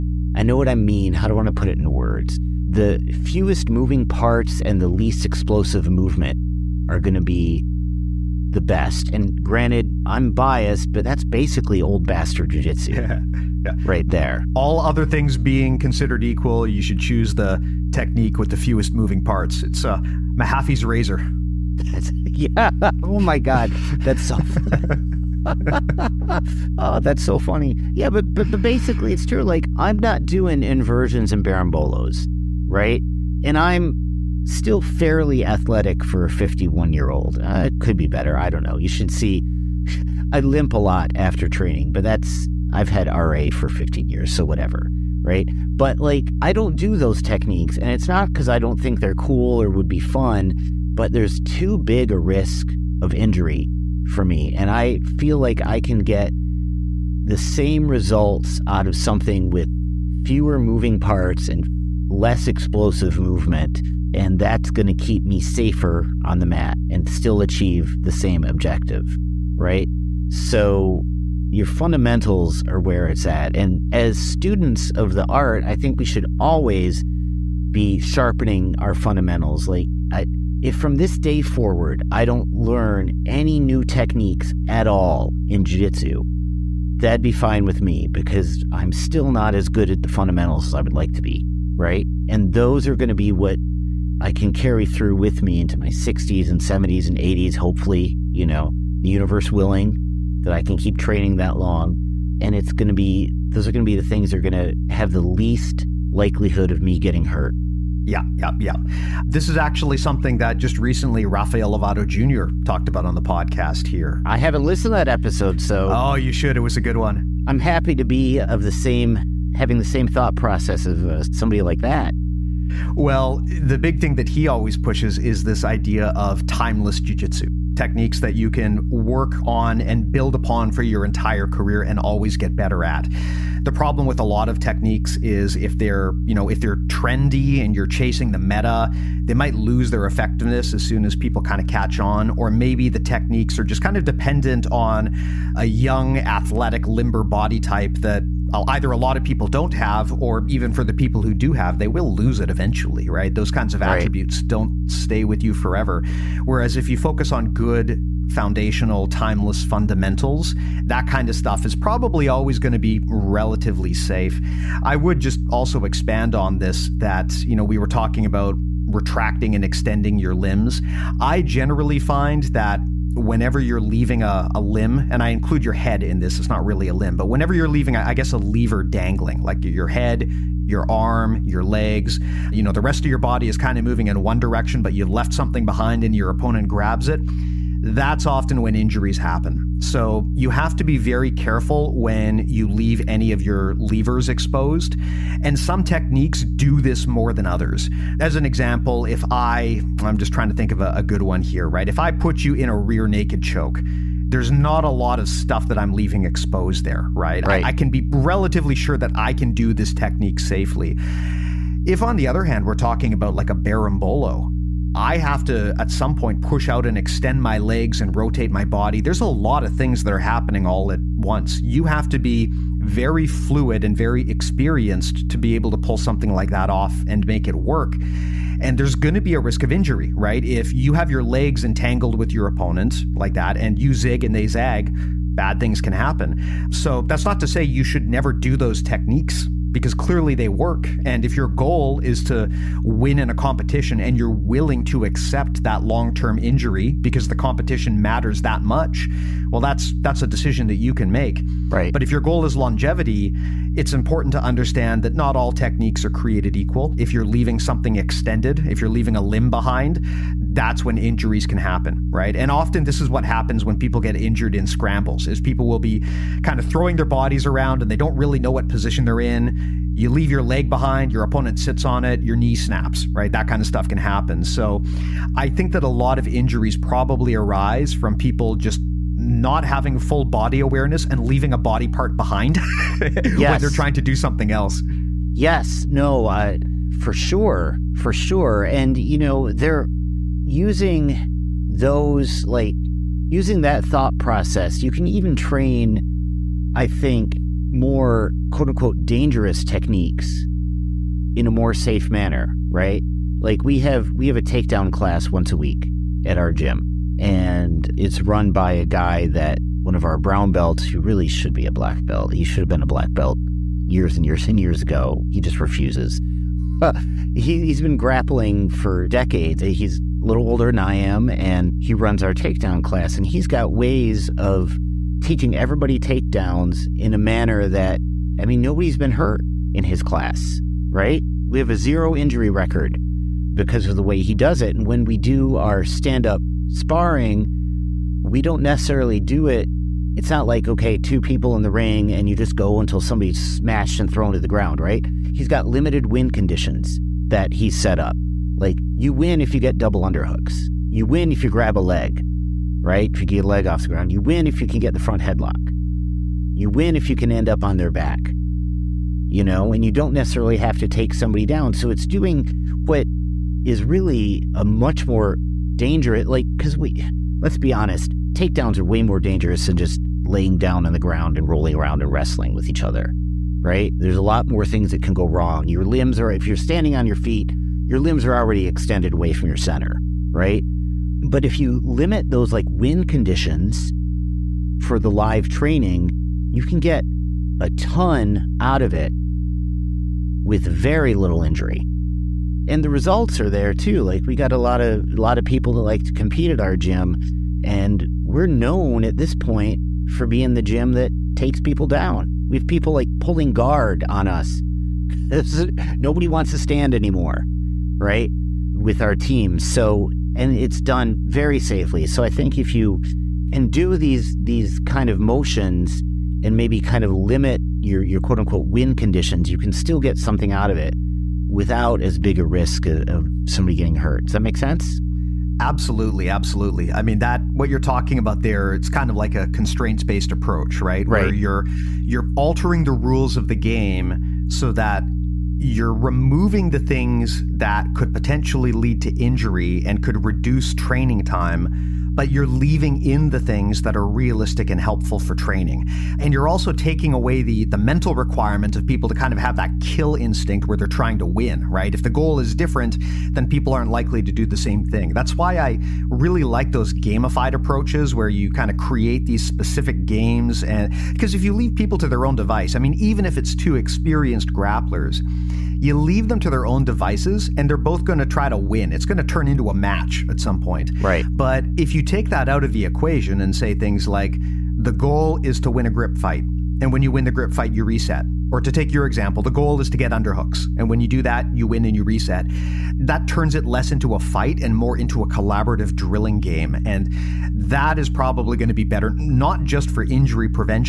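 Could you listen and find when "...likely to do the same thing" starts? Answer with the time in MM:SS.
07:33.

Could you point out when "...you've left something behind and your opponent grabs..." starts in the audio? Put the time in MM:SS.
03:04.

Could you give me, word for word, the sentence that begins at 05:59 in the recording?
You know, and you don't necessarily have to take somebody down.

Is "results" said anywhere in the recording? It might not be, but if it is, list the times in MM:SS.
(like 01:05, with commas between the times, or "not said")
00:57, 06:32.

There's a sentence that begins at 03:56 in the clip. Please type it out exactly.
So that's not to say you should never do those techniques because clearly they work.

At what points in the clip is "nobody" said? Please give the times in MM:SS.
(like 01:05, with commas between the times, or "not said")
05:28, 06:45.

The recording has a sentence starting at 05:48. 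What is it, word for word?
Like you win if you get double underhooks.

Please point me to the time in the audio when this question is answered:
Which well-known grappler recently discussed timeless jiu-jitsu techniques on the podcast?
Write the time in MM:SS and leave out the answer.
01:51.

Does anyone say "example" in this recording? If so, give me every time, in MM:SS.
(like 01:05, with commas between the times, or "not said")
03:18, 07:59.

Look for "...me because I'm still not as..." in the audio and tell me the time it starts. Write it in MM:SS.
01:27.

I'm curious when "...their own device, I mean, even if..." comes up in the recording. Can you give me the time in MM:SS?
07:42.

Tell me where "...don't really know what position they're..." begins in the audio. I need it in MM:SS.
04:27.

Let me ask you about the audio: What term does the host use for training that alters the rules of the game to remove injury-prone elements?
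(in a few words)
constraints-based approach.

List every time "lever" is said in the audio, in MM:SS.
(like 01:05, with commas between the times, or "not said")
02:58, 03:13.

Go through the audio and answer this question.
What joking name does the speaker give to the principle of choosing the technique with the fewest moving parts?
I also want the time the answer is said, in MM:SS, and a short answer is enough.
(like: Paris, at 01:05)
Mahaffey's razor, at 00:20.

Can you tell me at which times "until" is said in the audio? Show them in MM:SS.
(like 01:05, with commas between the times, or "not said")
05:42.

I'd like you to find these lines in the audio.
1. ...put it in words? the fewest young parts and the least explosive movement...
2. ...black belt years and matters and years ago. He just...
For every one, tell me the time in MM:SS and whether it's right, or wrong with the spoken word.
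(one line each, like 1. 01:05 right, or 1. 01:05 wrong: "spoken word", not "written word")
1. 00:01 wrong: "moving", not "young"
2. 05:12 wrong: "years", not "matters".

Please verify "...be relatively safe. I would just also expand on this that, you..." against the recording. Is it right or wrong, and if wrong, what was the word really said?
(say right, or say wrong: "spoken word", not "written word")
right.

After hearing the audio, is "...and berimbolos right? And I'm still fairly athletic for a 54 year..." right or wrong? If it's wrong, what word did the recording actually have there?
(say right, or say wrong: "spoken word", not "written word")
wrong: "51", not "54".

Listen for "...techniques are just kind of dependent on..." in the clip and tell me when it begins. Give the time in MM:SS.
02:22.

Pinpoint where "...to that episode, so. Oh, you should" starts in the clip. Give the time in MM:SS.
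01:54.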